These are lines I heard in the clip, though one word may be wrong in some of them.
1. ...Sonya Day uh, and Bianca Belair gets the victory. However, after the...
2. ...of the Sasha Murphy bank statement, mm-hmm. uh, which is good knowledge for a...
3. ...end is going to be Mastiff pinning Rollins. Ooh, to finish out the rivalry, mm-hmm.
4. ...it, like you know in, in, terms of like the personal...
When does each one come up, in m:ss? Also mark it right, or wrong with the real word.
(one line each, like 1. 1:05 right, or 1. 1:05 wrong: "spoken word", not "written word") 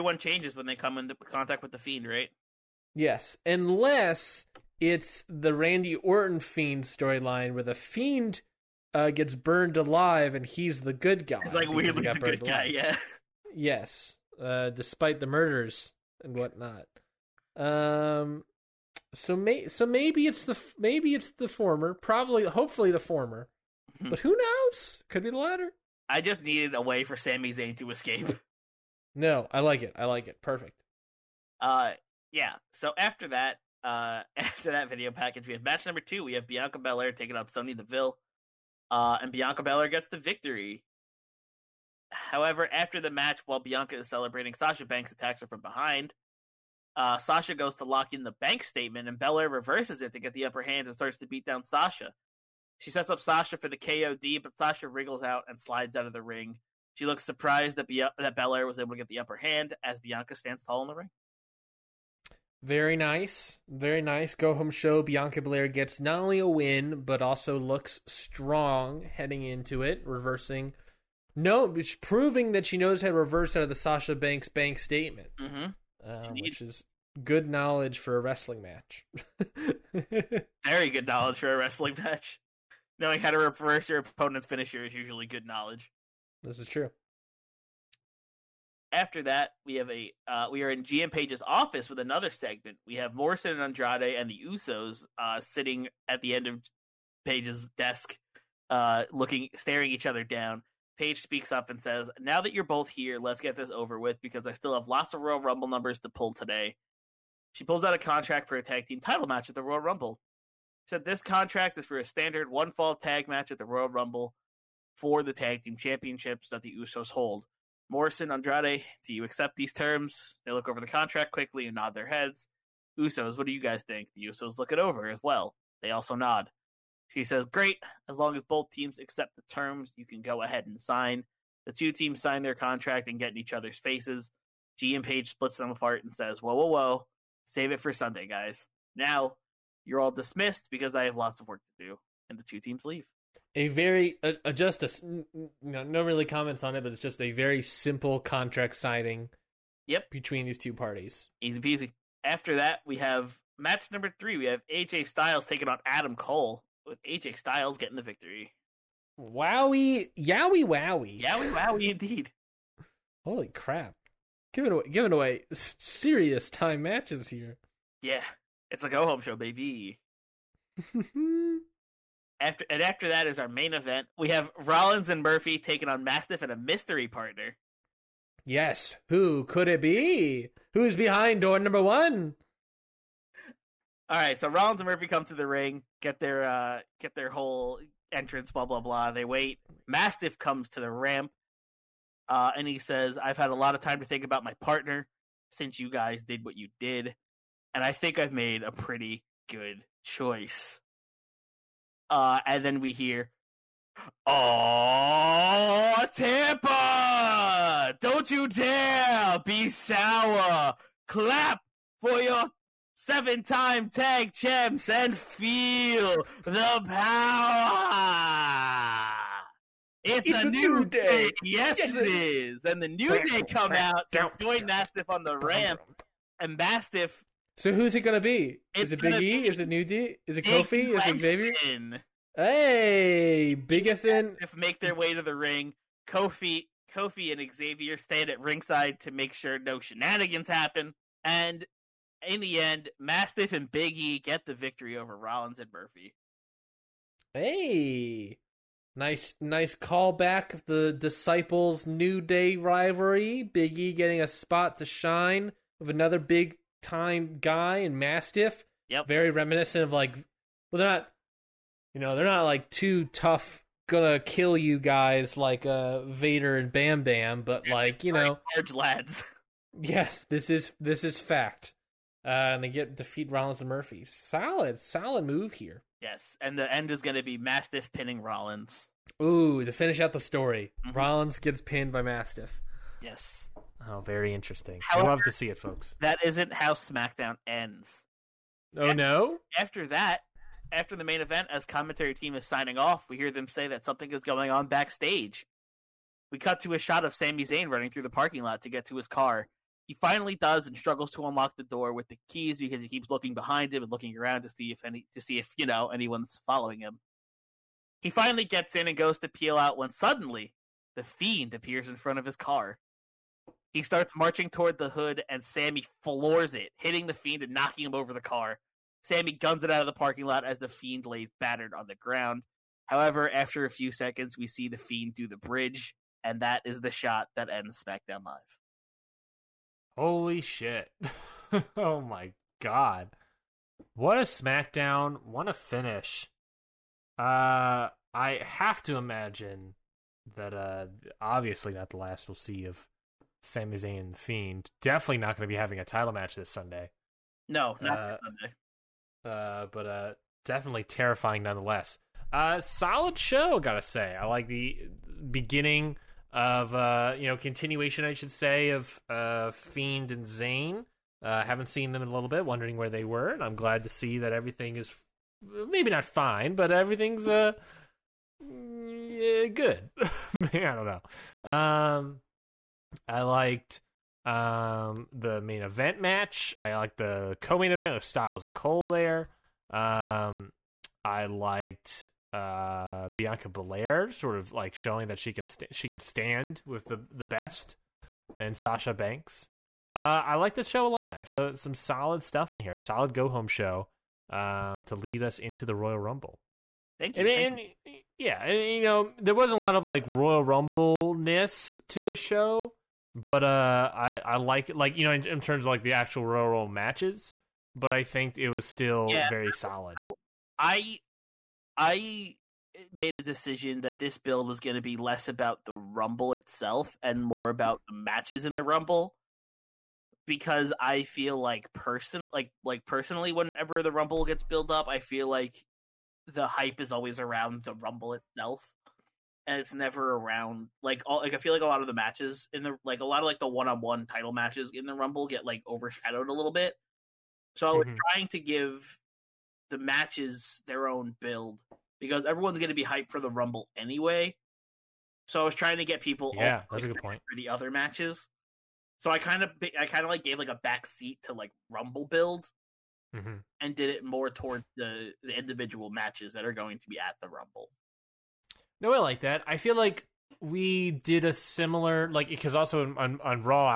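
1. 0:37 wrong: "Deville", not "Day"
2. 1:13 wrong: "Banks", not "Murphy"
3. 4:36 wrong: "story", not "rivalry"
4. 6:44 wrong: "actual", not "personal".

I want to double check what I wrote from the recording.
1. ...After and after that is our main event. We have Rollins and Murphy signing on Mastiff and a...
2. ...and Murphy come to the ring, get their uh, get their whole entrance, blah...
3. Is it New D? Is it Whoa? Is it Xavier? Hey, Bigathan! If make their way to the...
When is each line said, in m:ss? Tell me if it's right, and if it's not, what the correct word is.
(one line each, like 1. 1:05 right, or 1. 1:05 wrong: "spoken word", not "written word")
1. 2:52 wrong: "taking", not "signing"
2. 3:04 right
3. 3:49 wrong: "Kofi", not "Whoa".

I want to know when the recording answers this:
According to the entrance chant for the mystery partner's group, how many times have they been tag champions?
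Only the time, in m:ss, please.
3:32.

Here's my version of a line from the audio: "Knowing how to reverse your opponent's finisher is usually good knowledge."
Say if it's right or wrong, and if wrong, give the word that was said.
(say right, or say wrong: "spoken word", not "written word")
right.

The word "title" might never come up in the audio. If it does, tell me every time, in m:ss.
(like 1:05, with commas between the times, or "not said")
1:48, 5:45, 7:14.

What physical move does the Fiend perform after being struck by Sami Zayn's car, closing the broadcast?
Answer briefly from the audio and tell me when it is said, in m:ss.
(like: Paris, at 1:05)
the bridge, at 5:25.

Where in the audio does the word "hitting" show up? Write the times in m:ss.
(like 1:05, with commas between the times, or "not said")
5:16.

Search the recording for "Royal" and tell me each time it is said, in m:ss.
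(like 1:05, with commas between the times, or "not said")
1:45, 1:49, 1:53, 6:35, 6:40, 6:46.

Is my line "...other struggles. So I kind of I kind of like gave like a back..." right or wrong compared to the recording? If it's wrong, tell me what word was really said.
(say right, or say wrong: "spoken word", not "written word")
wrong: "matches", not "struggles".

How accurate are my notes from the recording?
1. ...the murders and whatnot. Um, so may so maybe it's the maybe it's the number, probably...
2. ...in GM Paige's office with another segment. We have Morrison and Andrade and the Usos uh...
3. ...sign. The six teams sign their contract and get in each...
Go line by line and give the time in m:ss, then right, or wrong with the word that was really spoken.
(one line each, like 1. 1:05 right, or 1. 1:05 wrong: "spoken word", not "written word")
1. 0:15 wrong: "former", not "number"
2. 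1:30 right
3. 2:10 wrong: "two", not "six".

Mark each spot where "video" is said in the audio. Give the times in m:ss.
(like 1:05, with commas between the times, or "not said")
0:34.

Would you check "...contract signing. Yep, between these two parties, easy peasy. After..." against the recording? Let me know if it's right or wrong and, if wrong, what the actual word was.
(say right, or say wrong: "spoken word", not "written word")
right.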